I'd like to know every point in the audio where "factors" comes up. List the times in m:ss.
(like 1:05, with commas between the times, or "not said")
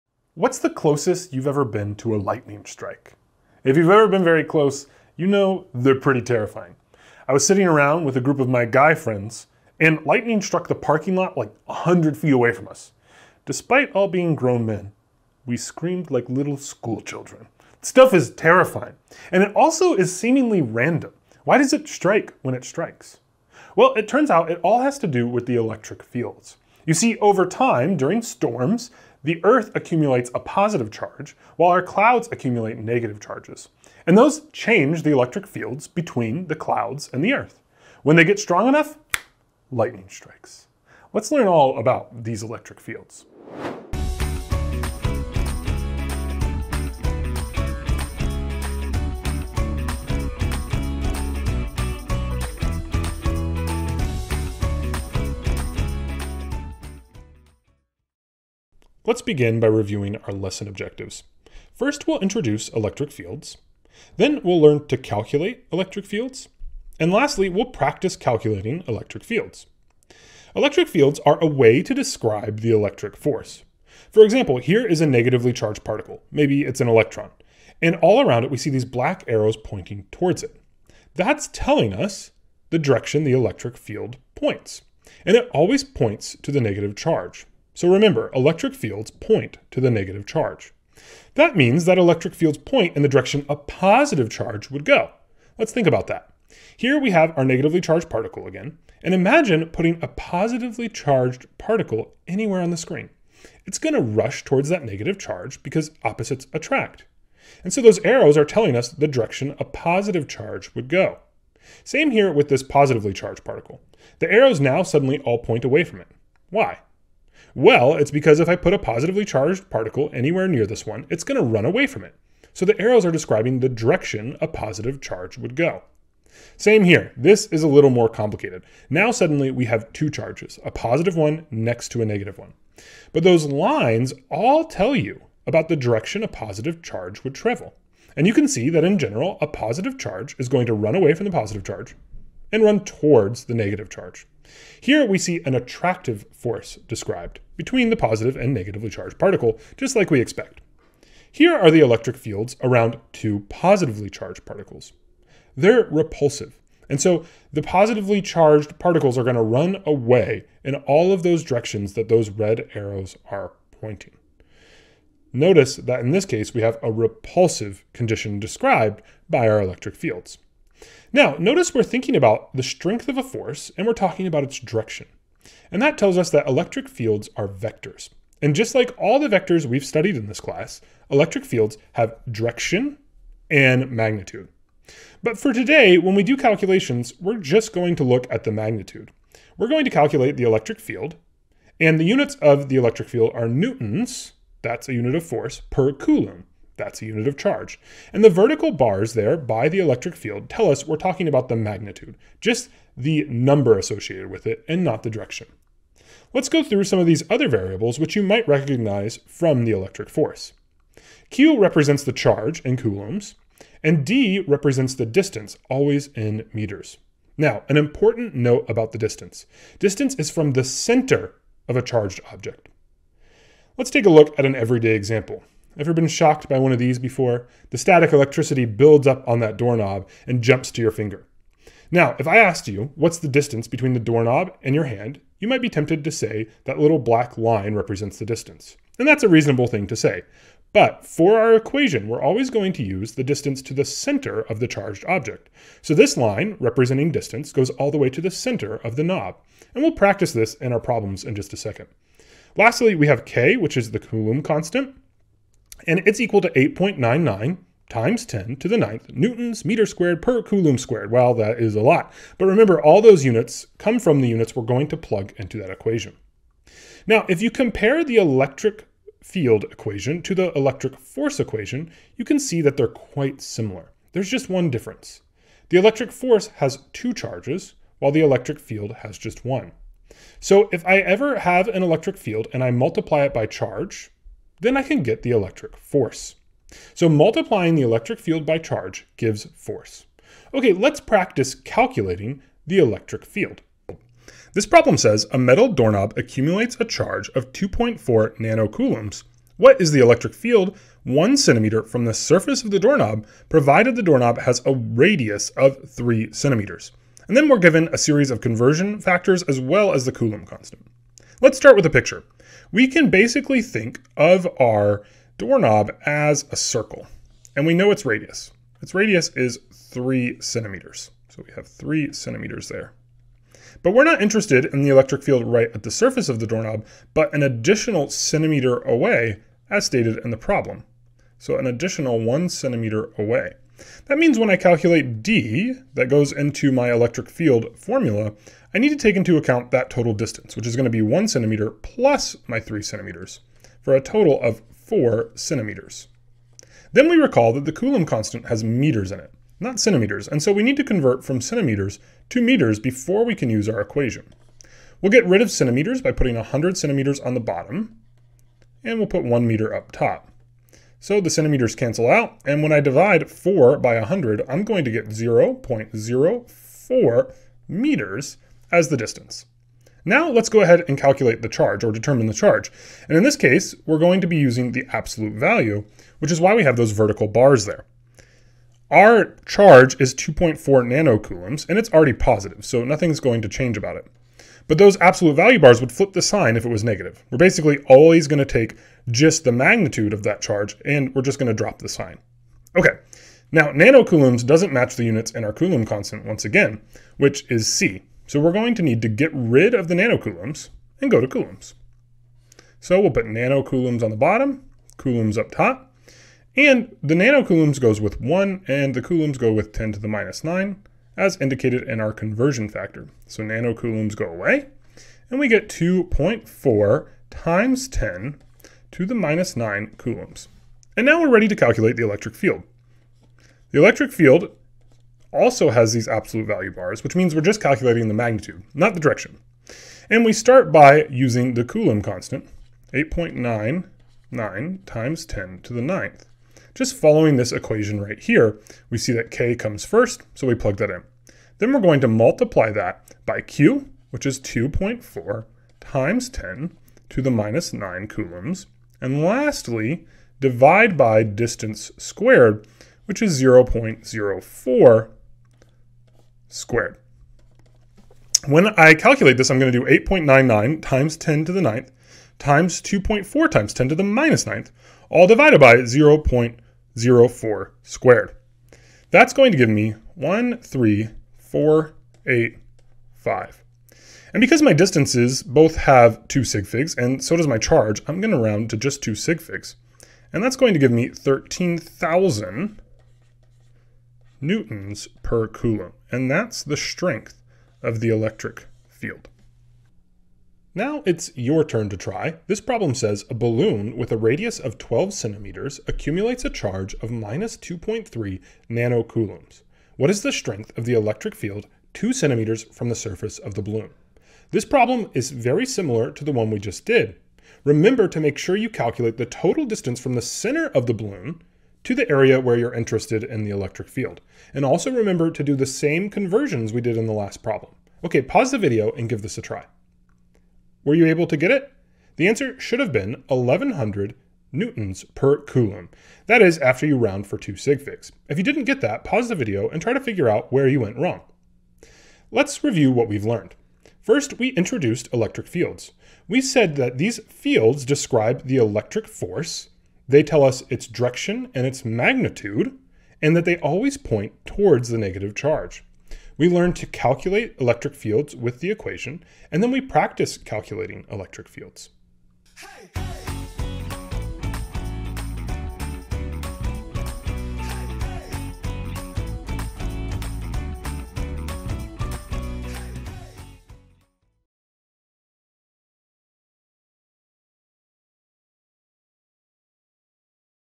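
5:08, 6:52.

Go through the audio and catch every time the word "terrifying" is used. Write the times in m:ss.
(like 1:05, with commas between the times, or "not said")
0:06, 0:18.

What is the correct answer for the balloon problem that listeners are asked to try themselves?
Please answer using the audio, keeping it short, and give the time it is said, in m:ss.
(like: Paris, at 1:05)
1100 newtons per coulomb, at 8:43.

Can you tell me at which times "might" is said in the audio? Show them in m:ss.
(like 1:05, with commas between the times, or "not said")
3:28, 3:55.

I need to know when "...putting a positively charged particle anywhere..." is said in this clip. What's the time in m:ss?
1:39.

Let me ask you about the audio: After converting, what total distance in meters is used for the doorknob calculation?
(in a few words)
0.04 meters.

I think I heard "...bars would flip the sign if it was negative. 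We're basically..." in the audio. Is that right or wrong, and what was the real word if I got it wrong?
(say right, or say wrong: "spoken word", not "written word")
right.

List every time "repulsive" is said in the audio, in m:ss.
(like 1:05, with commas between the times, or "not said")
2:35, 2:46.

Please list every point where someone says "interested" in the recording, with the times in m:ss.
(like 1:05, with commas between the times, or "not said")
5:24, 8:32.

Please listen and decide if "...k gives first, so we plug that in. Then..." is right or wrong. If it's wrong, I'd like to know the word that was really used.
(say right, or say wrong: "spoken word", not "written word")
wrong: "comes", not "gives".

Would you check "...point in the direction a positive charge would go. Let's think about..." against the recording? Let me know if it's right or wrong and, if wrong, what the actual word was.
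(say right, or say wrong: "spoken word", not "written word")
right.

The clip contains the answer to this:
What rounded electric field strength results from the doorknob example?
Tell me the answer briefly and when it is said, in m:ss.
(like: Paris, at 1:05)
13,000 newtons per coulomb, at 8:01.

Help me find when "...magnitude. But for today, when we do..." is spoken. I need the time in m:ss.
3:03.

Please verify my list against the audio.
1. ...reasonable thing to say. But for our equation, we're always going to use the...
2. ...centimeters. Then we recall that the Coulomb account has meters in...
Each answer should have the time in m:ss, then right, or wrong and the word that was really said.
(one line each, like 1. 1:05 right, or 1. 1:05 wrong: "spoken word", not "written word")
1. 3:59 right
2. 5:45 wrong: "constant", not "account".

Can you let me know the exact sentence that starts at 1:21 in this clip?
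That's telling us the direction the electric field points.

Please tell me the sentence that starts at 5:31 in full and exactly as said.
So an additional one centimeter away.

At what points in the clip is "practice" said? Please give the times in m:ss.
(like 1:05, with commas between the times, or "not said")
1:07, 4:09, 4:51, 9:09.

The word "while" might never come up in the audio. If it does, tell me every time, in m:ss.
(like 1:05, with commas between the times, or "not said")
0:31, 4:37.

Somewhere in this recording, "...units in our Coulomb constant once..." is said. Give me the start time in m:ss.
6:35.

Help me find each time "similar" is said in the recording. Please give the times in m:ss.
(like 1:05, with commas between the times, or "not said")
4:33, 8:25.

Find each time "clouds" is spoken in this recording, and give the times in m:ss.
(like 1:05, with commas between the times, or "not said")
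0:31, 0:36.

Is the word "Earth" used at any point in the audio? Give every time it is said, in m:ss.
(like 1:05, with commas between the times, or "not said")
0:29, 0:37.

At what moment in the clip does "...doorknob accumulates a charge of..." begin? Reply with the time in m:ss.
4:55.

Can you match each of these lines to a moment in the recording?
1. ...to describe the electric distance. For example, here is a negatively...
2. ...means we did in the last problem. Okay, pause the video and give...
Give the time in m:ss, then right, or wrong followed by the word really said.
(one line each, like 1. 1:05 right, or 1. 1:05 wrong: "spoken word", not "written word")
1. 1:11 wrong: "force", not "distance"
2. 8:36 wrong: "conversions", not "means".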